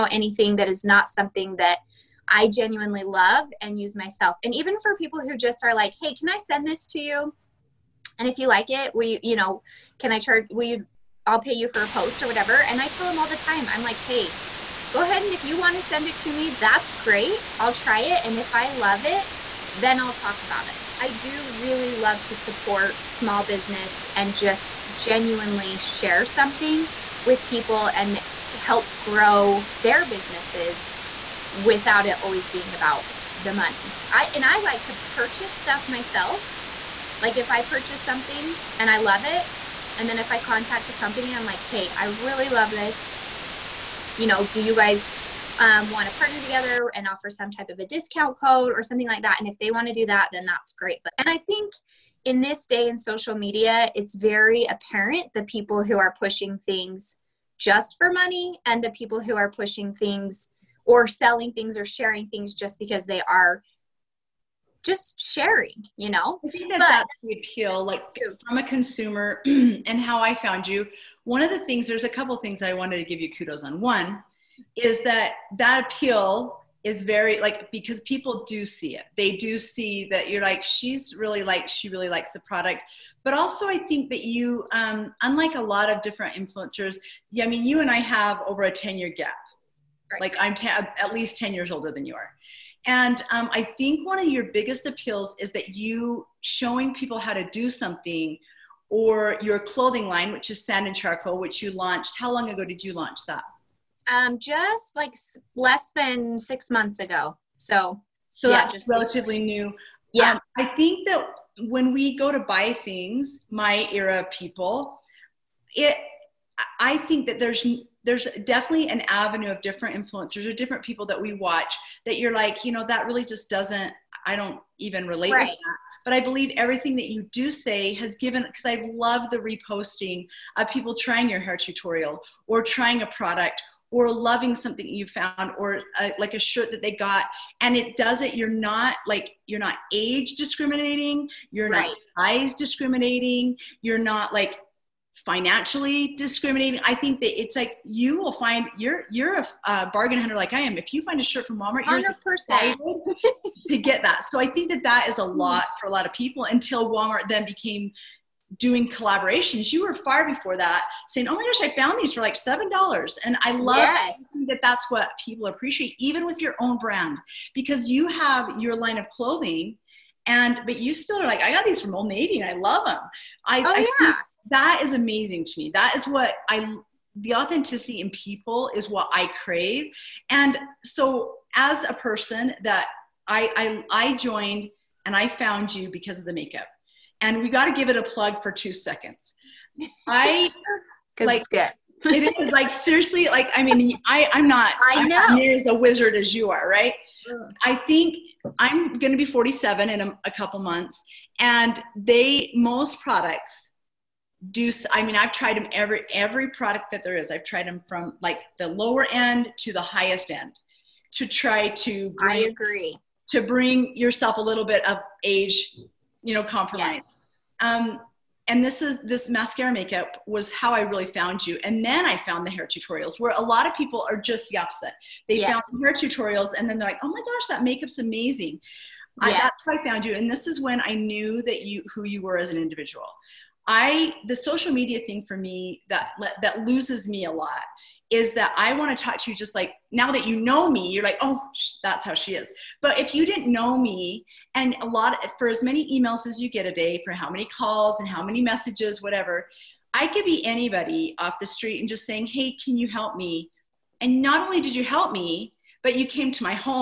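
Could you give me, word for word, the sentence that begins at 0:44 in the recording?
You know, do you guys um, want to partner together and offer some type of a discount code or something like that.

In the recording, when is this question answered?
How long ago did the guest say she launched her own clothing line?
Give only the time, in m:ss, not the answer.
1:45.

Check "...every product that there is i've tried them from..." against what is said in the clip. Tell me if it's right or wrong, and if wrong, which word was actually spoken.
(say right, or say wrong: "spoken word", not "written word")
right.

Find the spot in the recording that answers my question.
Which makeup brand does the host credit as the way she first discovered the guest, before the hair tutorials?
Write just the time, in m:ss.
3:39.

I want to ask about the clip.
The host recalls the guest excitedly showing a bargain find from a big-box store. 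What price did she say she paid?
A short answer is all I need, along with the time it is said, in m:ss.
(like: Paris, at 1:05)
$7, at 2:42.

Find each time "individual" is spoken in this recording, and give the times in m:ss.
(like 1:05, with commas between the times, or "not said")
3:52.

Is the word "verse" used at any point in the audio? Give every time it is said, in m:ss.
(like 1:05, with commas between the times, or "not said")
not said.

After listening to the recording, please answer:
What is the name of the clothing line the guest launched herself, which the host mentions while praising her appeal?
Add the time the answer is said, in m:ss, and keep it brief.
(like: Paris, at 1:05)
Sand and Charcoal, at 1:40.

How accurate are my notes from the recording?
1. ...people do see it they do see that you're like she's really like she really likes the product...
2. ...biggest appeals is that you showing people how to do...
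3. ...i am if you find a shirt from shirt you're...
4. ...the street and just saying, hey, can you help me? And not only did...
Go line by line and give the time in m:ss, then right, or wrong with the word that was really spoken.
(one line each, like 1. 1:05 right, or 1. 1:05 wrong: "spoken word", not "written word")
1. 1:18 right
2. 1:34 right
3. 2:30 wrong: "walmart", not "shirt"
4. 4:11 right.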